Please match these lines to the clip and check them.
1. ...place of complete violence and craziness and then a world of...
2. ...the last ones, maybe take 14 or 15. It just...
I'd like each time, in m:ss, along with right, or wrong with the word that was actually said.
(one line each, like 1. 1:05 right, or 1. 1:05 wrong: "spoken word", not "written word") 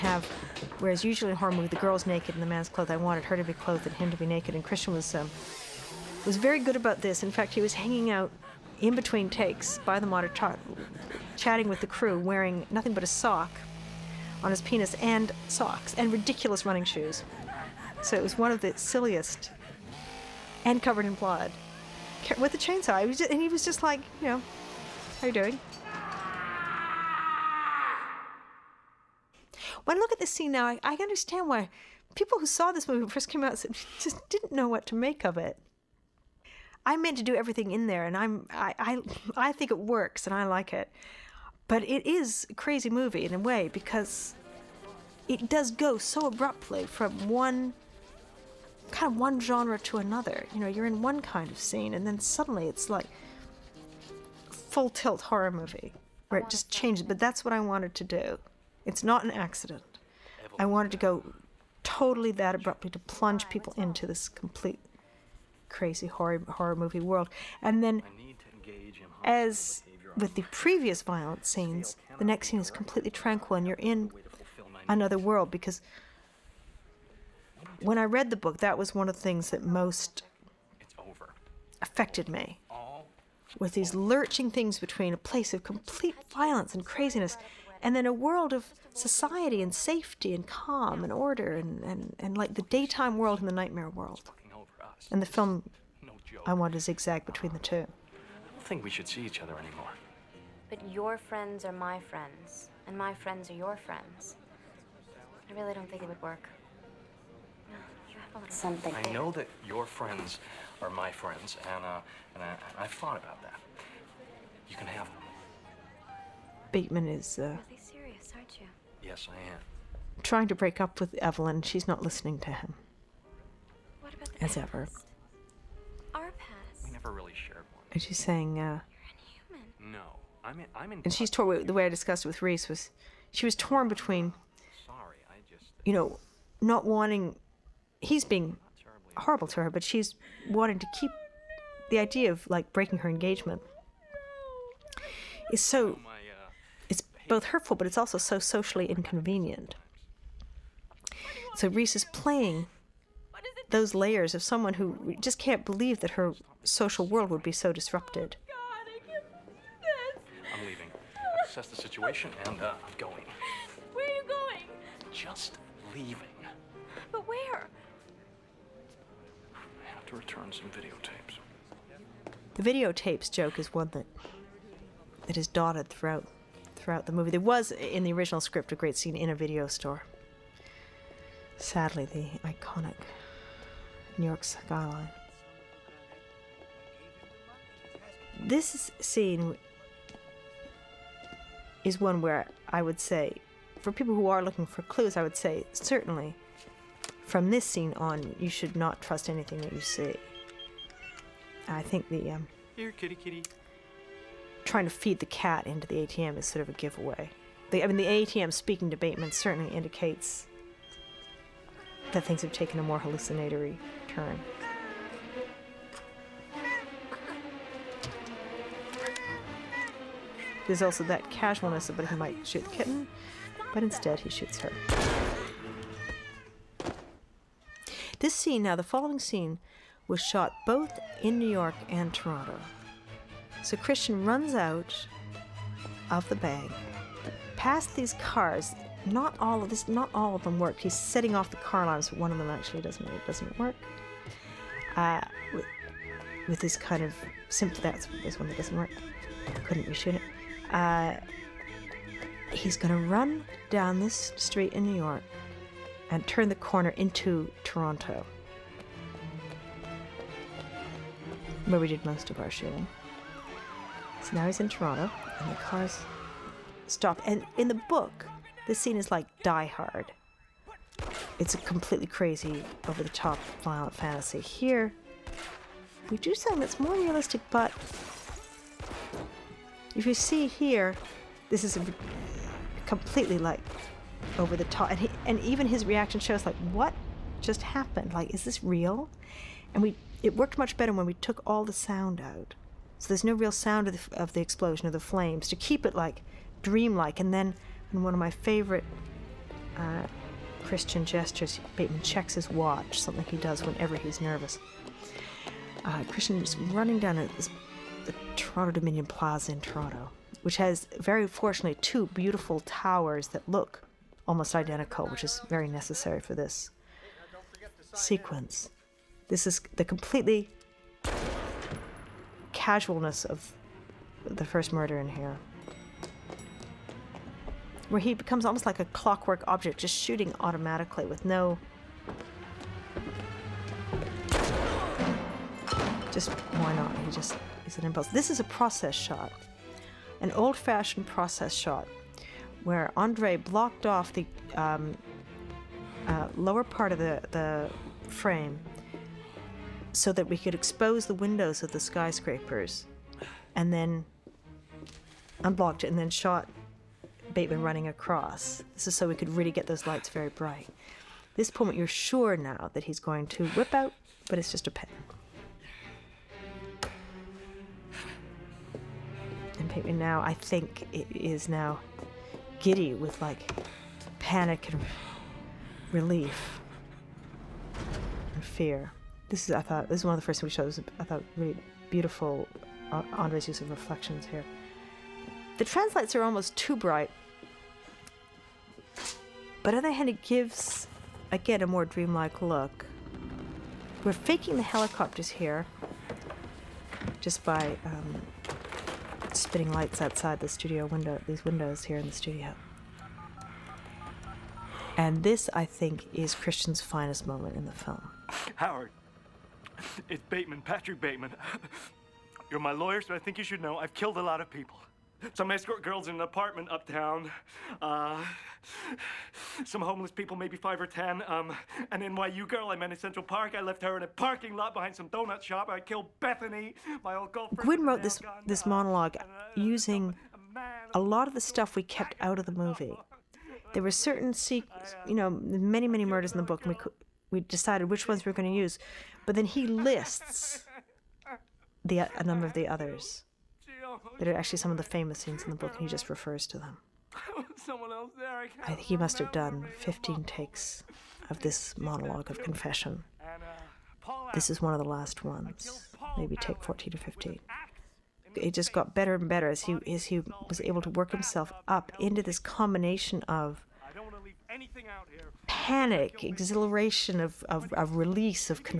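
1. 1:25 right
2. 7:34 right.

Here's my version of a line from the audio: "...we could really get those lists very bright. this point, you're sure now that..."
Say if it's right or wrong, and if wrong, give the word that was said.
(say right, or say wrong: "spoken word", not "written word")
wrong: "lights", not "lists".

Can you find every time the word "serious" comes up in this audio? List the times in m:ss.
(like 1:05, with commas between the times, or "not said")
1:57.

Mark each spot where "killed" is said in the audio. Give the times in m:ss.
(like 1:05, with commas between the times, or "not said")
6:53, 7:05.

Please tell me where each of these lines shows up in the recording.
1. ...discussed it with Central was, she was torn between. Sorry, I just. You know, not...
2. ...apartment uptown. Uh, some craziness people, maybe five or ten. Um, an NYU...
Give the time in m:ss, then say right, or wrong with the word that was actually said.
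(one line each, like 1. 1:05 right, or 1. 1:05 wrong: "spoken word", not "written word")
1. 2:11 wrong: "Reese", not "Central"
2. 6:56 wrong: "homeless", not "craziness".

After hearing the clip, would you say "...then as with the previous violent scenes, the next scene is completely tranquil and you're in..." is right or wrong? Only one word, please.
right.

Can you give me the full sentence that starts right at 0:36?
I meant to do everything in there, and I'm I, I I think it works, and I like it.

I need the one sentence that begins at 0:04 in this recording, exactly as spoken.
And Christian was um, was very good about this.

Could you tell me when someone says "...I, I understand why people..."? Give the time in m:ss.
0:30.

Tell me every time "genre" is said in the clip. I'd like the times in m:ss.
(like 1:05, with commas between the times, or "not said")
0:49.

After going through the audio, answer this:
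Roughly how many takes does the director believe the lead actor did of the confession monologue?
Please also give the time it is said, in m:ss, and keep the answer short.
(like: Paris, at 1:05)
15, at 7:29.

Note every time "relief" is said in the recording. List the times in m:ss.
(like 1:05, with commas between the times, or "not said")
6:15.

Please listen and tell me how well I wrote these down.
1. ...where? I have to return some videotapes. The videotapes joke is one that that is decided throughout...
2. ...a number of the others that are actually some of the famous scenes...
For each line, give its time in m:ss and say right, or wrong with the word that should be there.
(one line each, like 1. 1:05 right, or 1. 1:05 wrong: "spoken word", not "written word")
1. 2:47 wrong: "dotted", not "decided"
2. 7:21 right.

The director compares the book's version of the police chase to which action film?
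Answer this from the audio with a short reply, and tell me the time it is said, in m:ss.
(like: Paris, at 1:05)
Die Hard, at 4:29.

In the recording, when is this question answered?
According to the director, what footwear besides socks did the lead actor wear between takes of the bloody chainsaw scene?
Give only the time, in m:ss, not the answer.
0:16.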